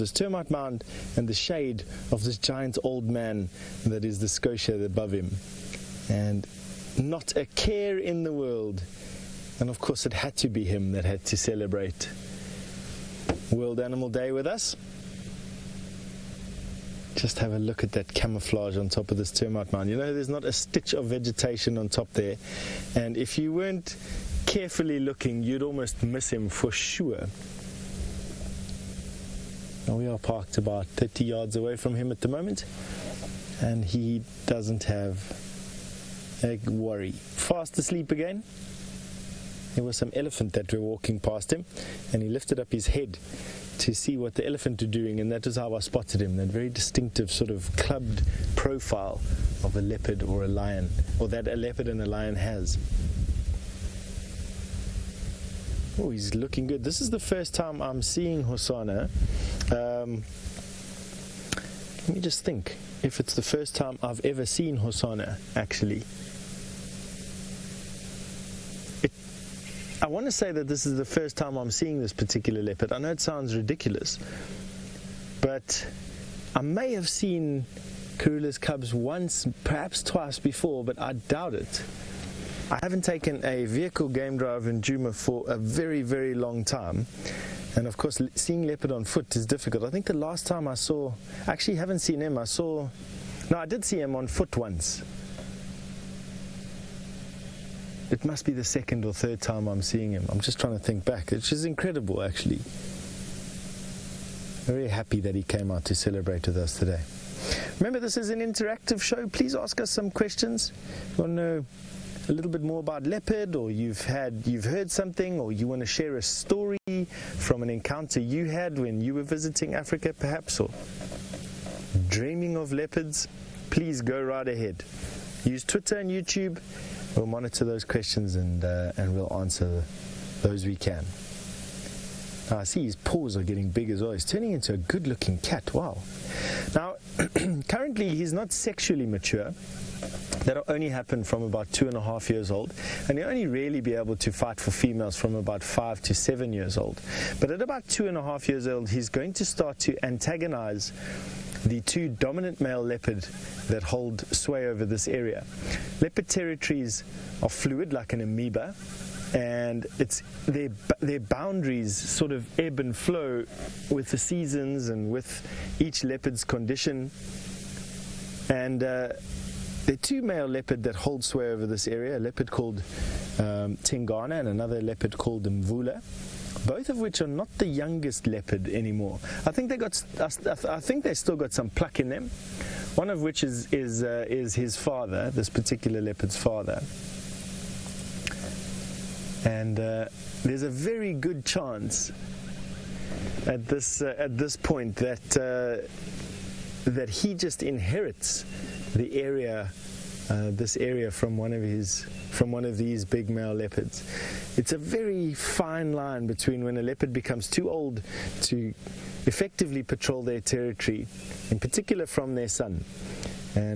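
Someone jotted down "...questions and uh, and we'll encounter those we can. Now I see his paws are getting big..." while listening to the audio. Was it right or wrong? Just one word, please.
wrong.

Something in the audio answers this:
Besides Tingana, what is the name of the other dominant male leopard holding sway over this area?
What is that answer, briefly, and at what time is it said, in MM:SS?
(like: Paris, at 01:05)
Mvula, at 02:55.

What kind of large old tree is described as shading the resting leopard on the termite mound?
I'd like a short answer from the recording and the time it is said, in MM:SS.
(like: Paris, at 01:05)
Schotia, at 00:04.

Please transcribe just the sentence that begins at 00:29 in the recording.
Now we are parked about 30 yards away from him at the moment, and he doesn't have a worry.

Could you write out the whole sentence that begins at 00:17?
Just have a look at that camouflage on top of this termite mound.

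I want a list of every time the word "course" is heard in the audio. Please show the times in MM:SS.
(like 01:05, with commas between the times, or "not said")
00:09, 01:27.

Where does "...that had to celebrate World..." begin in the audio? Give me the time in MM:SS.
00:10.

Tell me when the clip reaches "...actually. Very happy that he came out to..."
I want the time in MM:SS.
01:42.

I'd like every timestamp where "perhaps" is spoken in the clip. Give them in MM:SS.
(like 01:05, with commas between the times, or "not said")
01:19, 02:00.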